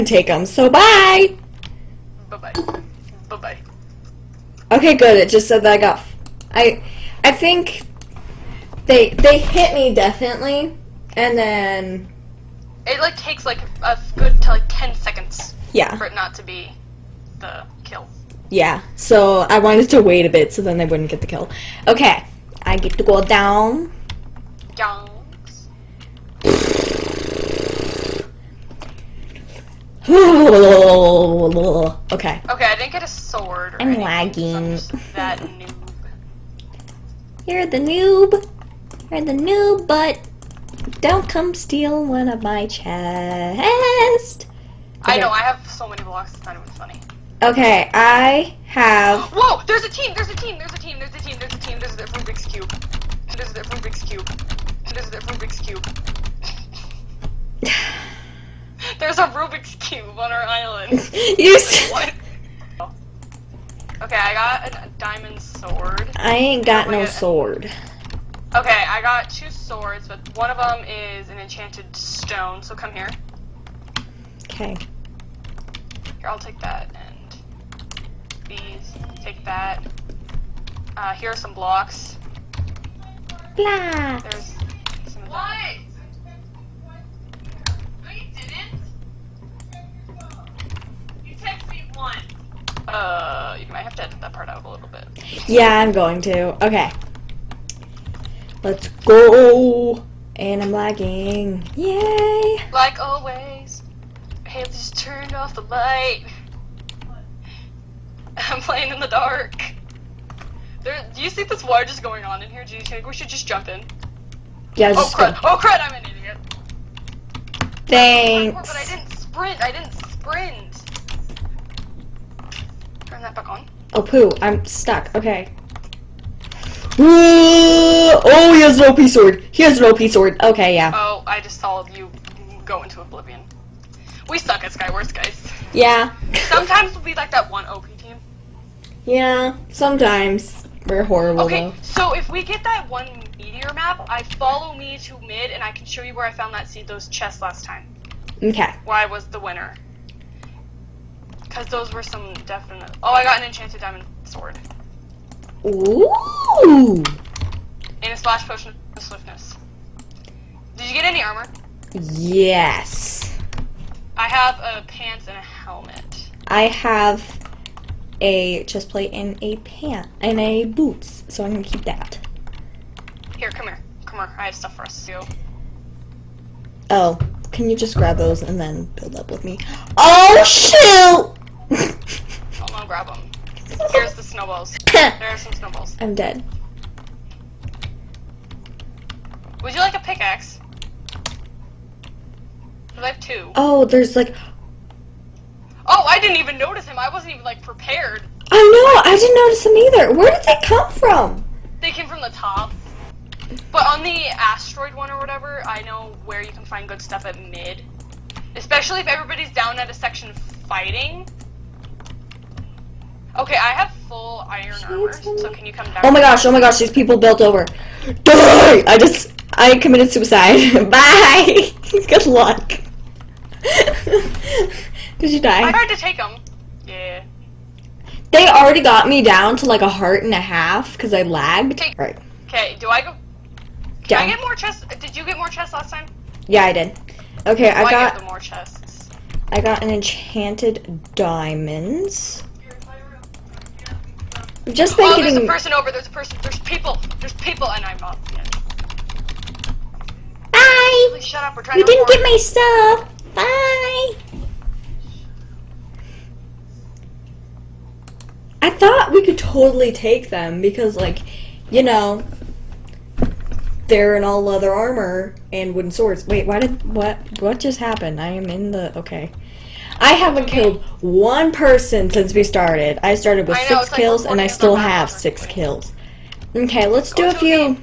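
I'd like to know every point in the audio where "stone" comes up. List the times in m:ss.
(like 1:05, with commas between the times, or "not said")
1:11.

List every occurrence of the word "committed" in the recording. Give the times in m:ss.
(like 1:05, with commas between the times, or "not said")
3:39.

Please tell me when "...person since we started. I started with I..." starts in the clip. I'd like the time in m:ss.
4:31.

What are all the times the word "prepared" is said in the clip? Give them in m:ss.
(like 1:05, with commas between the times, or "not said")
3:17.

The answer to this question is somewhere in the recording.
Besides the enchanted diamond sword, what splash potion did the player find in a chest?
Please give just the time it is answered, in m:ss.
2:39.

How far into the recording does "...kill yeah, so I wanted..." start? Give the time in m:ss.
0:17.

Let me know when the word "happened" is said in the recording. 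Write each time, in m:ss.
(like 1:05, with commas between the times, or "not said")
4:27.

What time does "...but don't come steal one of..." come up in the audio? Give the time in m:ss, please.
0:39.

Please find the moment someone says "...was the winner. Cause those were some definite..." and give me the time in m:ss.
2:29.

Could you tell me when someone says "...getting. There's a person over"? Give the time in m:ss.
4:05.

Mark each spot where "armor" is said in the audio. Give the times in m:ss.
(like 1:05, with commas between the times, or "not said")
2:41, 3:34, 4:24.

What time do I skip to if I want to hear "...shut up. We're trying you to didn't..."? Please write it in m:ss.
4:11.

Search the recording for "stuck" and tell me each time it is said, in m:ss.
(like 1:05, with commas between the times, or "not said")
2:04.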